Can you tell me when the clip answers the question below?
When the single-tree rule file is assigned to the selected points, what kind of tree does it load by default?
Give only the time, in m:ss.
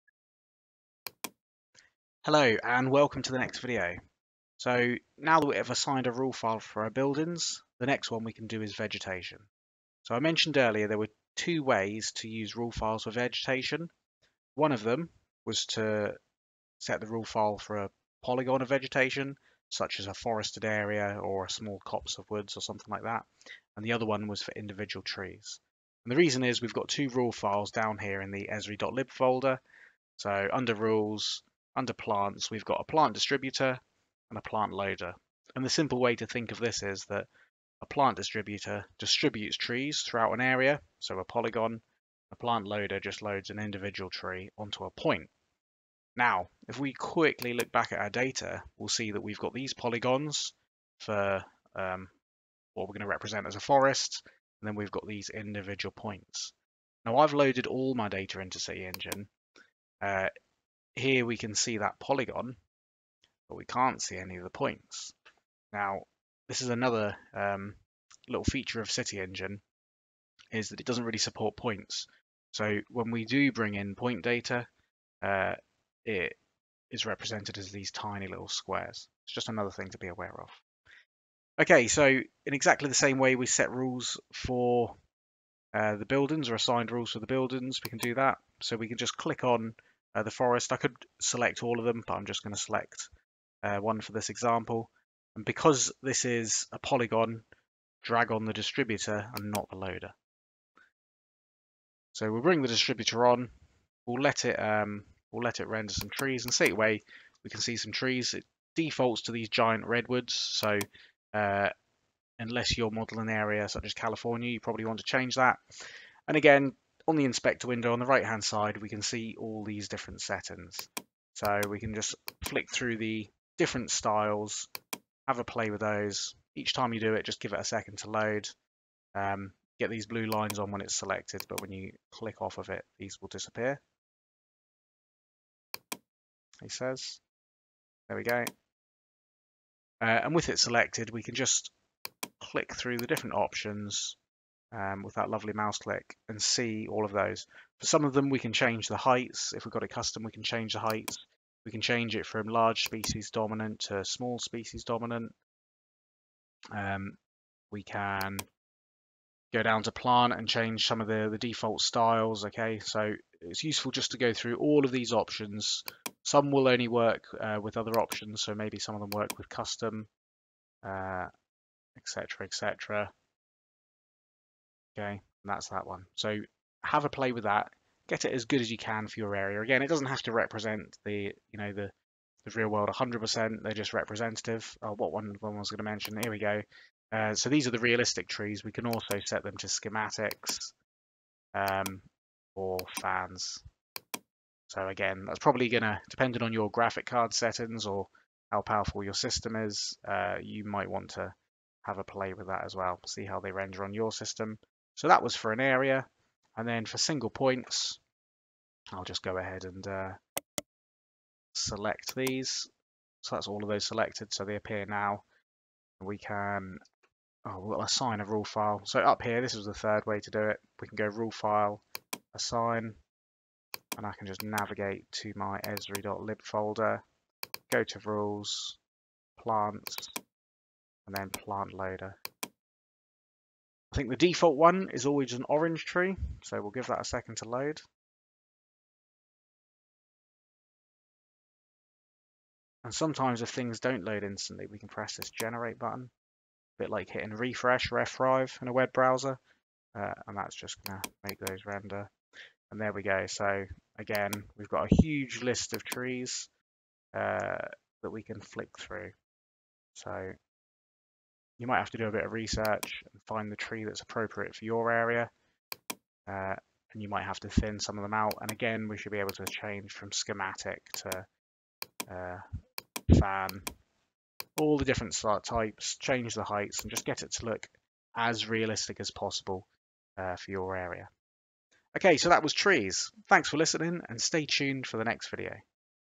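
3:55.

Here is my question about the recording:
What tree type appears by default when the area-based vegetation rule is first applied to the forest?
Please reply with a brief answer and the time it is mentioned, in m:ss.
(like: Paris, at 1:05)
Giant redwoods, at 1:49.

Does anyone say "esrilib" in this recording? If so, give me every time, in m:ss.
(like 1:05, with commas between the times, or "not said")
0:28, 3:45.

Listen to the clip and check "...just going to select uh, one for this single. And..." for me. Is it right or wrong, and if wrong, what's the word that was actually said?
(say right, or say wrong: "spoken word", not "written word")
wrong: "example", not "single".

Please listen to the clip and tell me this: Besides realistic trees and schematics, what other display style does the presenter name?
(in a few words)
Fans.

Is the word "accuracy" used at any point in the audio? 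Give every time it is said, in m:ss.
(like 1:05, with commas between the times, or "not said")
not said.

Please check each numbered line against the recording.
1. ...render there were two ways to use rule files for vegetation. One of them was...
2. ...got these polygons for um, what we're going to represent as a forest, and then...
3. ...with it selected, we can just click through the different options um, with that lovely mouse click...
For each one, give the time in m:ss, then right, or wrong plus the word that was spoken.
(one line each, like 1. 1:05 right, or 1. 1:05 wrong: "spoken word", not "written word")
1. 0:10 wrong: "earlier", not "render"
2. 0:49 right
3. 2:20 right.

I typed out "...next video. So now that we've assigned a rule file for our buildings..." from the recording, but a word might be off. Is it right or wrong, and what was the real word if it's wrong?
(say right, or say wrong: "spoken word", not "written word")
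right.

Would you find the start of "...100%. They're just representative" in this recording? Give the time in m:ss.
3:02.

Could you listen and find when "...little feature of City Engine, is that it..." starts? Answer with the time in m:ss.
1:08.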